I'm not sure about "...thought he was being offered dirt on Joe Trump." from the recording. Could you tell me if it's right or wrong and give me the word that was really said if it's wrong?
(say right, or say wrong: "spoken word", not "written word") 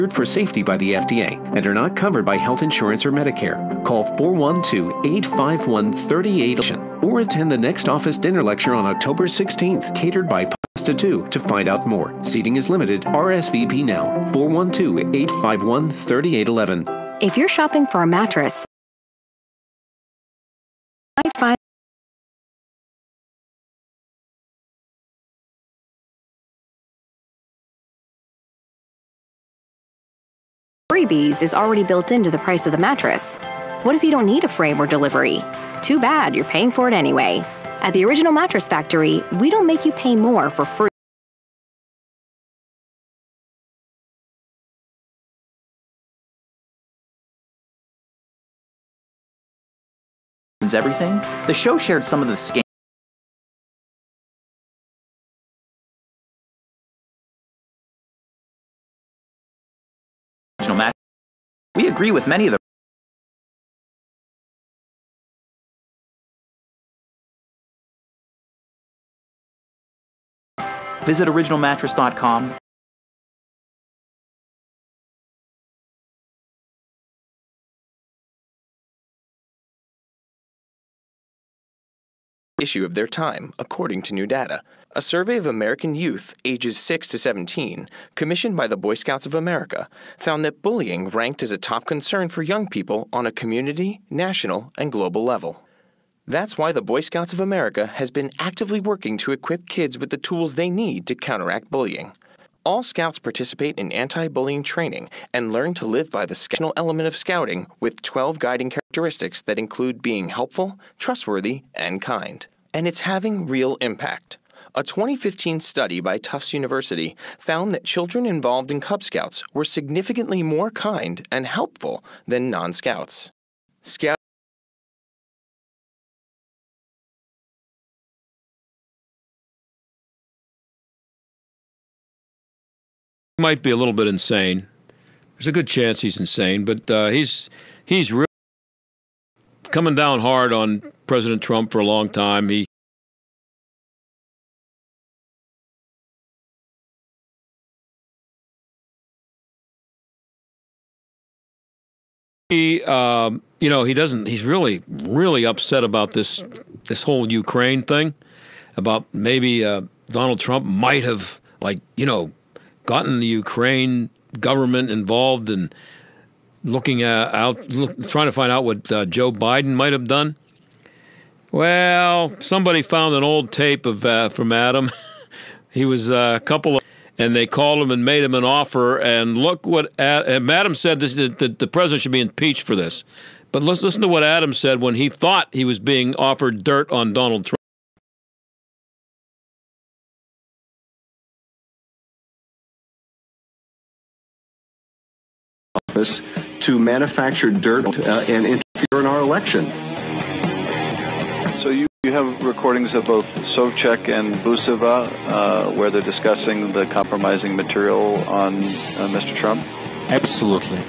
wrong: "Donald", not "Joe".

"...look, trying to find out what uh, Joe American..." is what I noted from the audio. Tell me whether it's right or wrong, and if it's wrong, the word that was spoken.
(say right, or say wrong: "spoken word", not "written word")
wrong: "Biden", not "American".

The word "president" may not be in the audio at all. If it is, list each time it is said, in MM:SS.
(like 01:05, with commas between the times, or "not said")
02:21, 03:01.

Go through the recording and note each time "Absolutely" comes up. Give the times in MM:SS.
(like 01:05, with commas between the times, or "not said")
03:30.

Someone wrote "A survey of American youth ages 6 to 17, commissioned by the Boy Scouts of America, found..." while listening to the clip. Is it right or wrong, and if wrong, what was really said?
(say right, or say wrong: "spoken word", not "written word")
right.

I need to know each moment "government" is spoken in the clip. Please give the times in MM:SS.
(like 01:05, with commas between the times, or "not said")
02:44.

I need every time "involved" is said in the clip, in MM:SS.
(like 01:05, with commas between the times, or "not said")
01:58, 02:44.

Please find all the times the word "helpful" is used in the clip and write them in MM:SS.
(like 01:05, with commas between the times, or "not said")
01:50, 02:01.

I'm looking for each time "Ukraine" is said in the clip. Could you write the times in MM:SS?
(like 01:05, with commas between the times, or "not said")
02:37, 02:43.